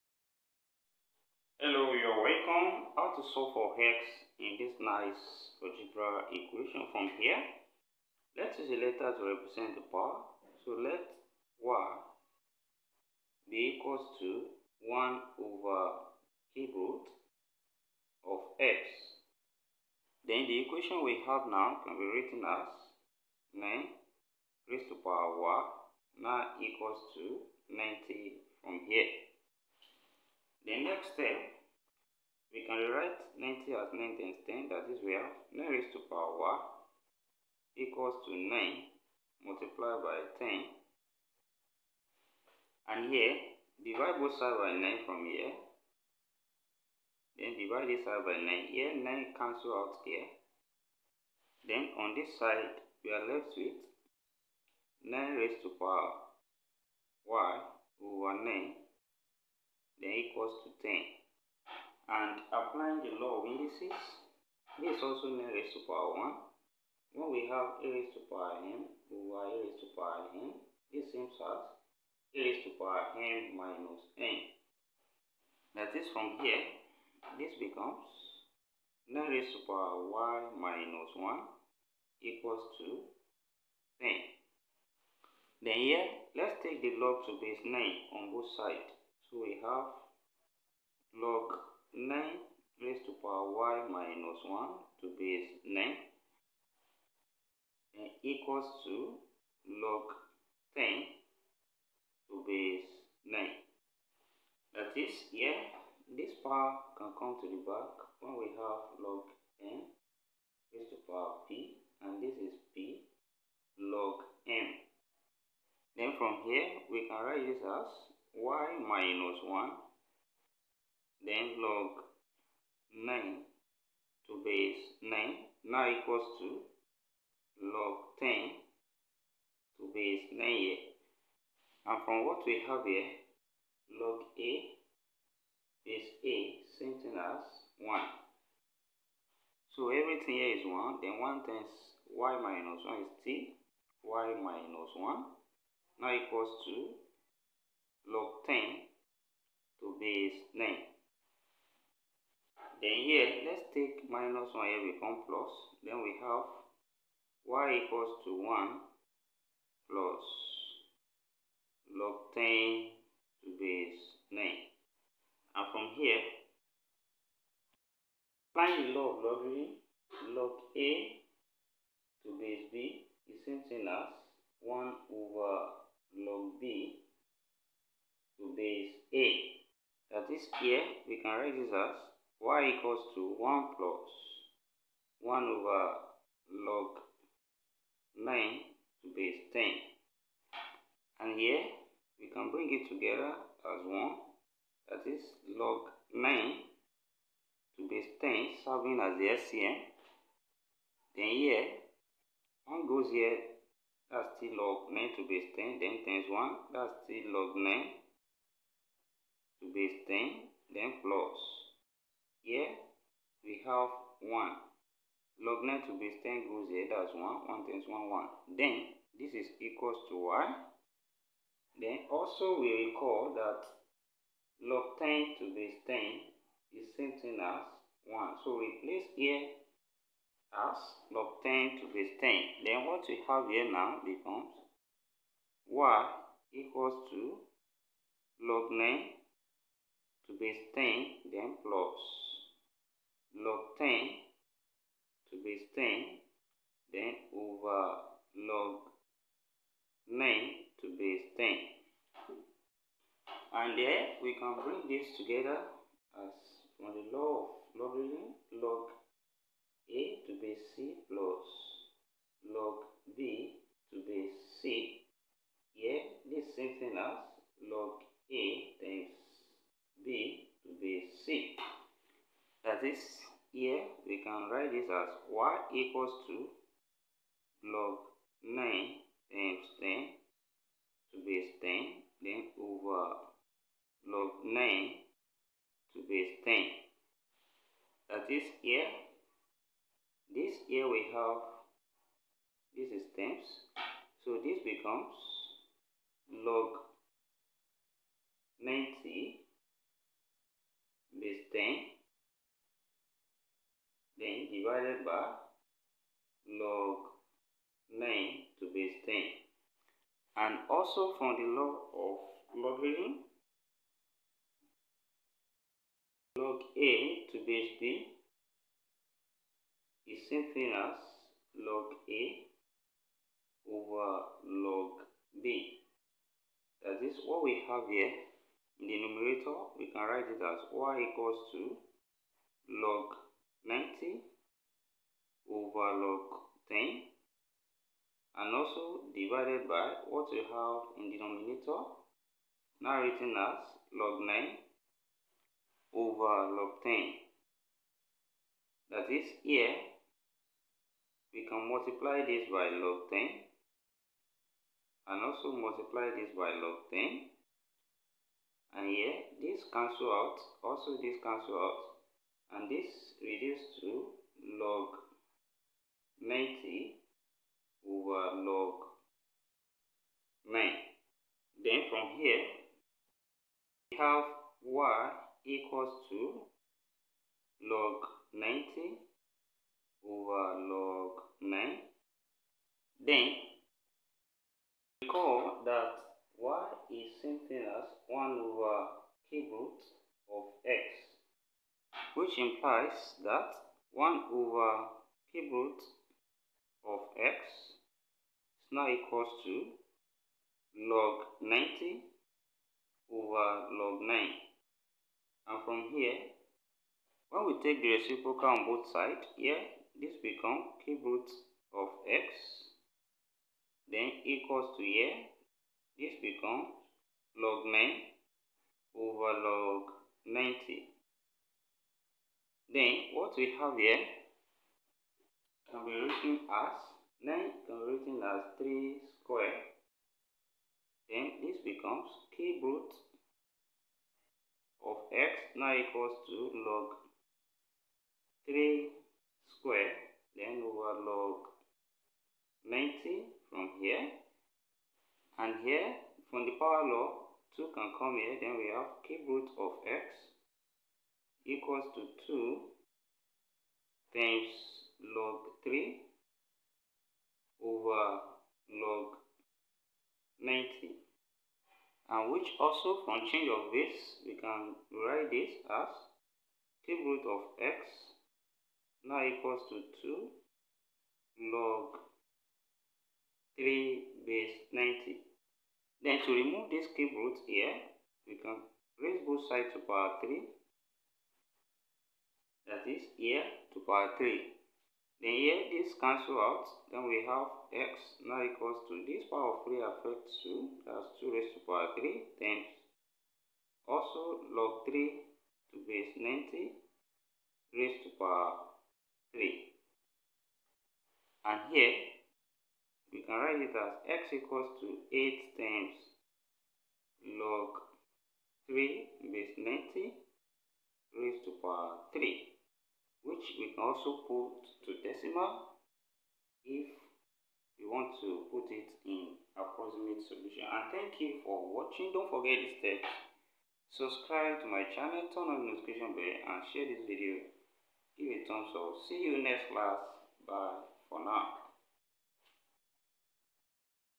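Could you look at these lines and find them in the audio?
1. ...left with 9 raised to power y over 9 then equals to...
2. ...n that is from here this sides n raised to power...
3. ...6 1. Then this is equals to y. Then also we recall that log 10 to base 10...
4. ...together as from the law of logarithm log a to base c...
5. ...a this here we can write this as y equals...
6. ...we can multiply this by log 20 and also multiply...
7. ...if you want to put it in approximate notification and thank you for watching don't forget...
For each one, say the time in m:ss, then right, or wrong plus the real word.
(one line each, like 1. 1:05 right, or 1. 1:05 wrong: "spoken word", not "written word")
1. 0:53 right
2. 1:14 wrong: "becomes", not "sides"
3. 3:37 wrong: "1", not "6"
4. 4:15 right
5. 4:28 right
6. 5:51 wrong: "10", not "20"
7. 8:36 wrong: "solution", not "notification".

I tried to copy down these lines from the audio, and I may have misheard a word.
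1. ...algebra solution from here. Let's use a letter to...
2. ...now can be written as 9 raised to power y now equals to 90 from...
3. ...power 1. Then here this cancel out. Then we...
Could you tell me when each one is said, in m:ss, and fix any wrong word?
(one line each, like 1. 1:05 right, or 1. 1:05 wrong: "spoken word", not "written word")
1. 0:05 wrong: "equation", not "solution"
2. 0:21 right
3. 8:03 wrong: "3", not "1".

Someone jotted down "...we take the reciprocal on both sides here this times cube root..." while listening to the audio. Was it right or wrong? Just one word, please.
wrong.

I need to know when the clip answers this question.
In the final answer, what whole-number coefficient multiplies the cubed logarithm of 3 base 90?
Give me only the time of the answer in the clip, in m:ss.
8:25.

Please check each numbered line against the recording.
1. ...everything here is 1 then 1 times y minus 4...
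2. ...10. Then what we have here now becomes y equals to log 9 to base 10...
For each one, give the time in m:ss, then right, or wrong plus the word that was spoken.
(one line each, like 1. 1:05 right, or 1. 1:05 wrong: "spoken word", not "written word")
1. 2:19 wrong: "1", not "4"
2. 3:52 right.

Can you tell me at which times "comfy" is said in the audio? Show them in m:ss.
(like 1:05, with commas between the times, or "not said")
not said.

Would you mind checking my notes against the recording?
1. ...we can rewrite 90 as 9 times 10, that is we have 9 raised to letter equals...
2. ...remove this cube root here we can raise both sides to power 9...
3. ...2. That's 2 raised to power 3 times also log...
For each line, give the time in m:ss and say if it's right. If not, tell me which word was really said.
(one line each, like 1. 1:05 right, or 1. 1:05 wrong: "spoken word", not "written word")
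1. 0:32 wrong: "power", not "letter"
2. 7:56 wrong: "3", not "9"
3. 8:10 right.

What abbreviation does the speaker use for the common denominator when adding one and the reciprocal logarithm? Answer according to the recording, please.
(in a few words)
SCM.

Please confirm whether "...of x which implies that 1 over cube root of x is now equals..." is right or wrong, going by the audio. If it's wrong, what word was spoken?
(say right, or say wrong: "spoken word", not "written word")
right.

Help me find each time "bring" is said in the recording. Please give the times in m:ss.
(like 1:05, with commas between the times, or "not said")
3:12, 4:14.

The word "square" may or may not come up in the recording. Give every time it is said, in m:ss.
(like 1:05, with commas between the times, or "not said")
7:09, 7:19.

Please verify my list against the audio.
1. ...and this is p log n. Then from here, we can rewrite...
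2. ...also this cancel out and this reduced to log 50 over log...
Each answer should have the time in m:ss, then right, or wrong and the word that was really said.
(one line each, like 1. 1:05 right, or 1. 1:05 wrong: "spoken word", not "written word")
1. 1:52 wrong: "write", not "rewrite"
2. 6:00 wrong: "90", not "50".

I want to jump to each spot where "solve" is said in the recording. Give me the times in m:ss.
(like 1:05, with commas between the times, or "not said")
0:03.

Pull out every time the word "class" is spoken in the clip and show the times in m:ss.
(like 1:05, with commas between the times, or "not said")
8:49.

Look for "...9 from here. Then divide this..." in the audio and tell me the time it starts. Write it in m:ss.
0:44.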